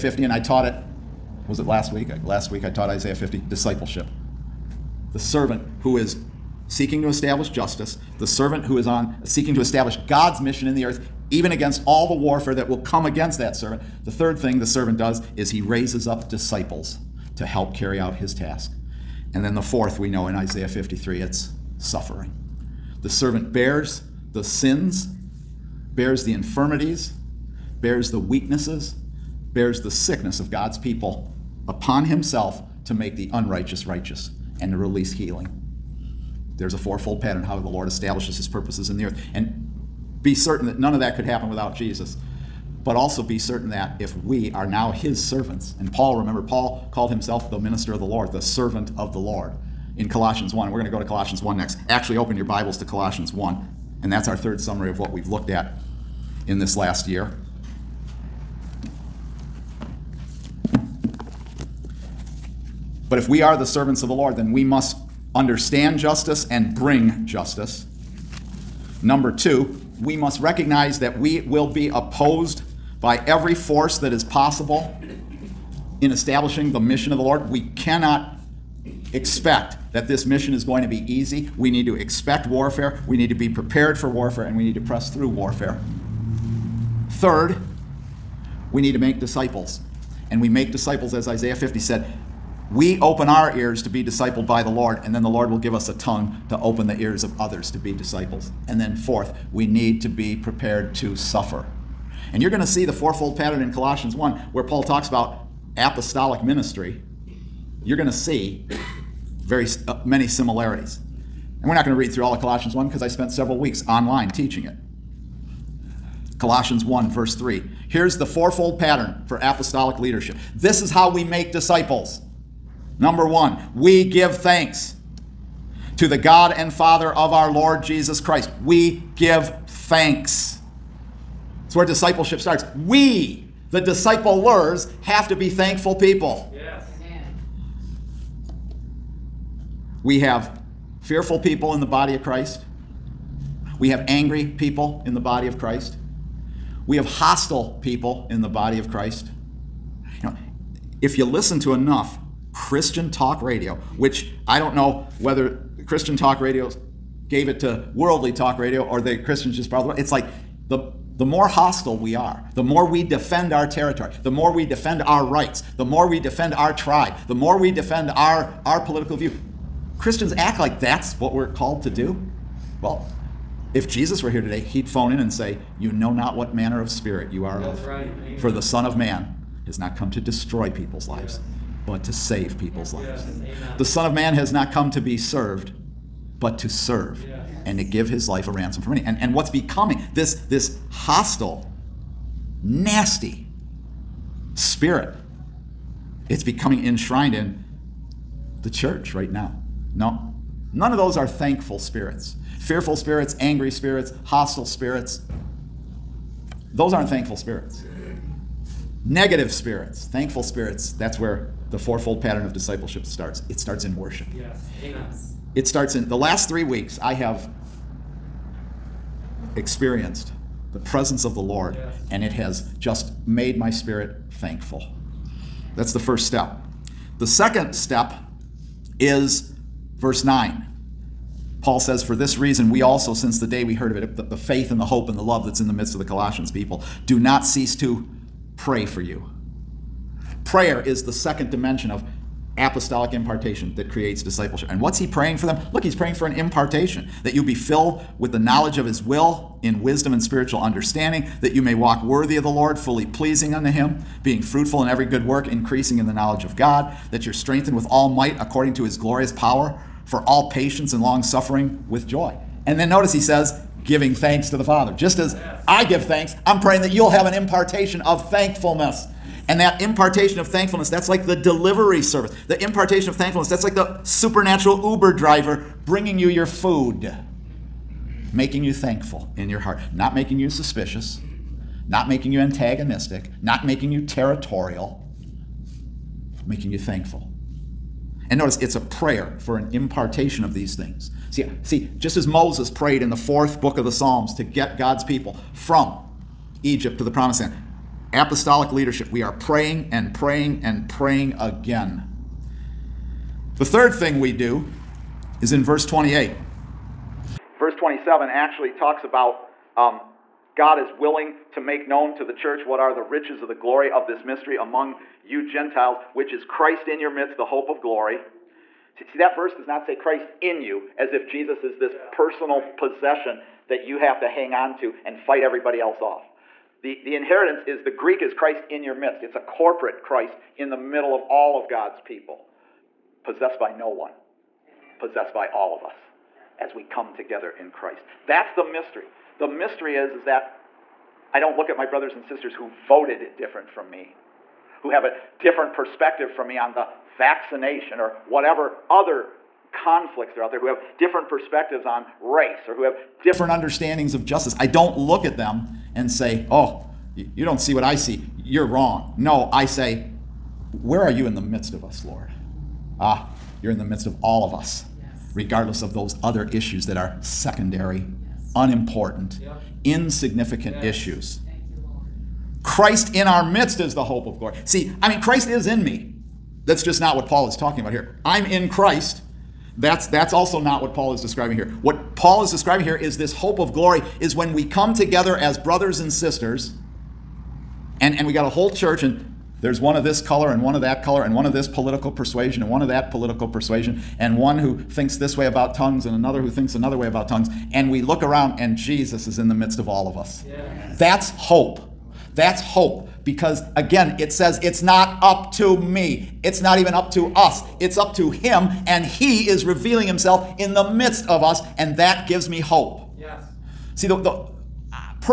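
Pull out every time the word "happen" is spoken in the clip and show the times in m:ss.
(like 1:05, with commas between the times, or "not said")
0:41.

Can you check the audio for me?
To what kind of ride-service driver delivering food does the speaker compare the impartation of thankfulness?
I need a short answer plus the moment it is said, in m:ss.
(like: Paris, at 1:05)
Uber driver, at 4:34.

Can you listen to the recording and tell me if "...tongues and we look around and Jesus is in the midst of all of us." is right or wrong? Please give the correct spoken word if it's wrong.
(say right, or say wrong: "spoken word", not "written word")
right.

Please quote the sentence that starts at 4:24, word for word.
Just as I give thanks, I'm praying that you'll have an impartation of thankfulness.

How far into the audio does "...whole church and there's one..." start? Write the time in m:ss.
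6:28.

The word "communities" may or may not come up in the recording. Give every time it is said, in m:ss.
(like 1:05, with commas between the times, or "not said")
not said.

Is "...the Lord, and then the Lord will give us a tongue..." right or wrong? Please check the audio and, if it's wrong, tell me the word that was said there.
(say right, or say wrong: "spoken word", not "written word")
right.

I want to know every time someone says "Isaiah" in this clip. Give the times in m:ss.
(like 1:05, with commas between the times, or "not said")
0:02, 0:20, 1:31.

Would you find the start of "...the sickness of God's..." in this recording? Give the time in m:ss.
0:29.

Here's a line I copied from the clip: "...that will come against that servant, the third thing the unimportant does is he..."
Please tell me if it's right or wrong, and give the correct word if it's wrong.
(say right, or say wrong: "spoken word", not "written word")
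wrong: "servant", not "unimportant".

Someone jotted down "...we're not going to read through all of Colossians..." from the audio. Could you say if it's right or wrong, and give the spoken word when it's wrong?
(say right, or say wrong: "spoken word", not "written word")
right.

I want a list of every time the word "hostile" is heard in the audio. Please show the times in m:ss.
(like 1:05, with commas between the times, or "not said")
2:27, 2:41, 3:10, 3:24.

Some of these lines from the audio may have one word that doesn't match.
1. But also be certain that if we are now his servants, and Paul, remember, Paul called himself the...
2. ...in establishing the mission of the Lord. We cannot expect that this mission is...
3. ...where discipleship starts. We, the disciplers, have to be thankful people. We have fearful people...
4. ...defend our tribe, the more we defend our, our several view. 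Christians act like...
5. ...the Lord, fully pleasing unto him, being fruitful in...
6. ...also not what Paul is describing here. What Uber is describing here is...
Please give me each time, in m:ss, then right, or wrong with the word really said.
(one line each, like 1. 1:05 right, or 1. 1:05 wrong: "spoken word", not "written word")
1. 0:42 right
2. 1:16 right
3. 2:11 right
4. 2:46 wrong: "political", not "several"
5. 4:12 right
6. 6:20 wrong: "Paul", not "Uber".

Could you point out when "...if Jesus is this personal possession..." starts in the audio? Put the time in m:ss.
5:21.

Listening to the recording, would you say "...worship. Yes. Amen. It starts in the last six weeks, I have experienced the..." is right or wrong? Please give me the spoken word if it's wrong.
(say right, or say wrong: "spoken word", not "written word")
wrong: "three", not "six".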